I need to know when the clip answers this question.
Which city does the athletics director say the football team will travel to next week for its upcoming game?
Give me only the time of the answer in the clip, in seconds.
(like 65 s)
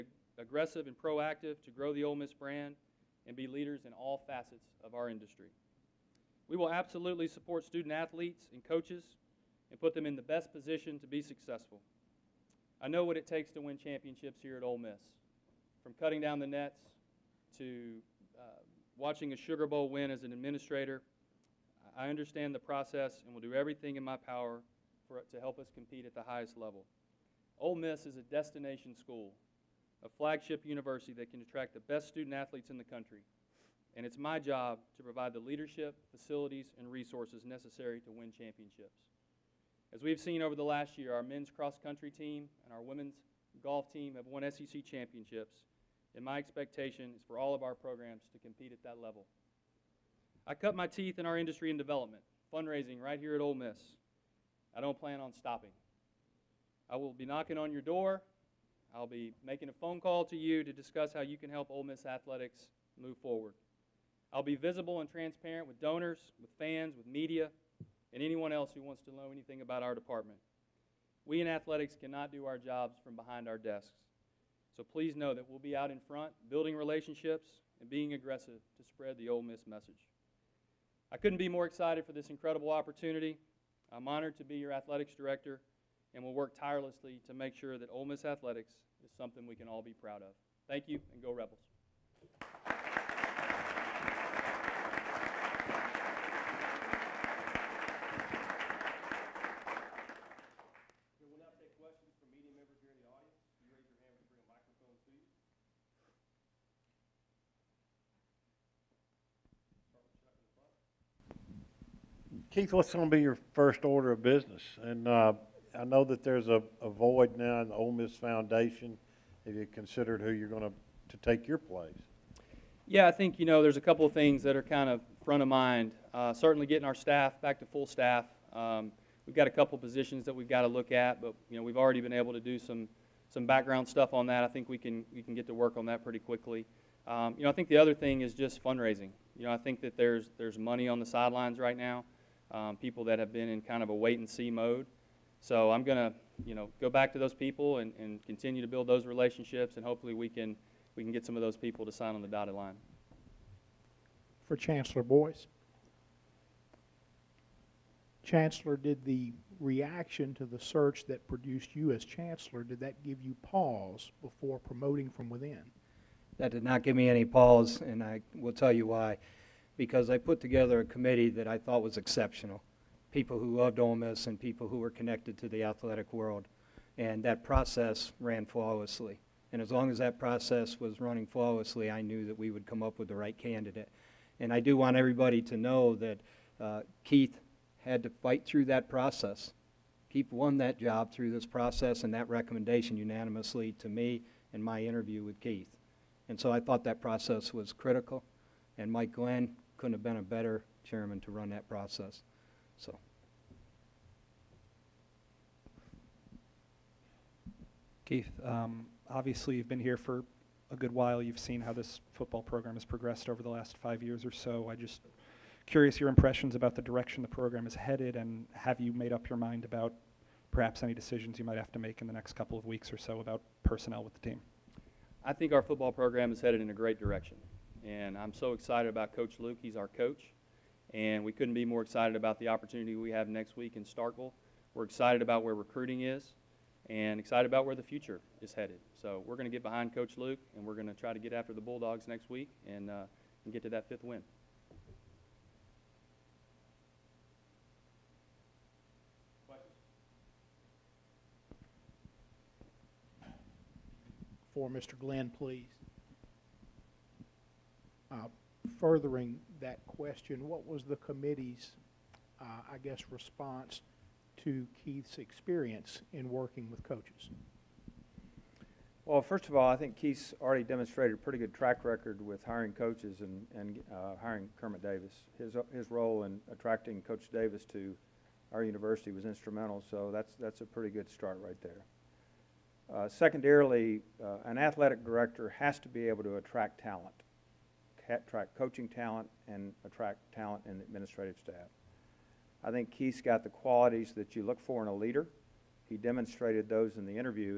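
233 s.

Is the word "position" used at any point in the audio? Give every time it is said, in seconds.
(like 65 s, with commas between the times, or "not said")
10 s, 129 s.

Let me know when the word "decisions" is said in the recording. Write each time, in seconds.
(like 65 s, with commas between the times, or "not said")
220 s.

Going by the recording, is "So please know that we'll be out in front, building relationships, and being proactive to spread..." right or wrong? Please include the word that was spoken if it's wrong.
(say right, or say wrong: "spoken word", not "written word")
wrong: "aggressive", not "proactive".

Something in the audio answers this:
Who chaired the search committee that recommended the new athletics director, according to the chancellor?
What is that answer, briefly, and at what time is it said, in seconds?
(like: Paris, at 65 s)
Mike Glenn, at 198 s.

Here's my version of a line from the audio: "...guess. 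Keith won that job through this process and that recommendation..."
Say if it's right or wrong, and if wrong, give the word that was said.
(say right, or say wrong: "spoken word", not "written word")
wrong: "process", not "guess".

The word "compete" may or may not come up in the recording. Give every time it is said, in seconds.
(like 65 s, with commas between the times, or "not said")
25 s, 48 s.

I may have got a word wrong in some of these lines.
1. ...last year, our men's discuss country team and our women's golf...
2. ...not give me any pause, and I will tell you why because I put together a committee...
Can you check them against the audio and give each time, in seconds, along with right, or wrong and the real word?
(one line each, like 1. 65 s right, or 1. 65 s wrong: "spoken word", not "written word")
1. 40 s wrong: "cross", not "discuss"
2. 166 s right.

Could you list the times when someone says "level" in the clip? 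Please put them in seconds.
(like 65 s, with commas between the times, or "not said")
26 s, 48 s.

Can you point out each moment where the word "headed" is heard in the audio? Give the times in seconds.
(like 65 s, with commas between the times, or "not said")
217 s, 226 s, 238 s.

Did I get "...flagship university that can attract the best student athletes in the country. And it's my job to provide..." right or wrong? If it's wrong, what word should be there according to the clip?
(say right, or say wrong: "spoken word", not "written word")
right.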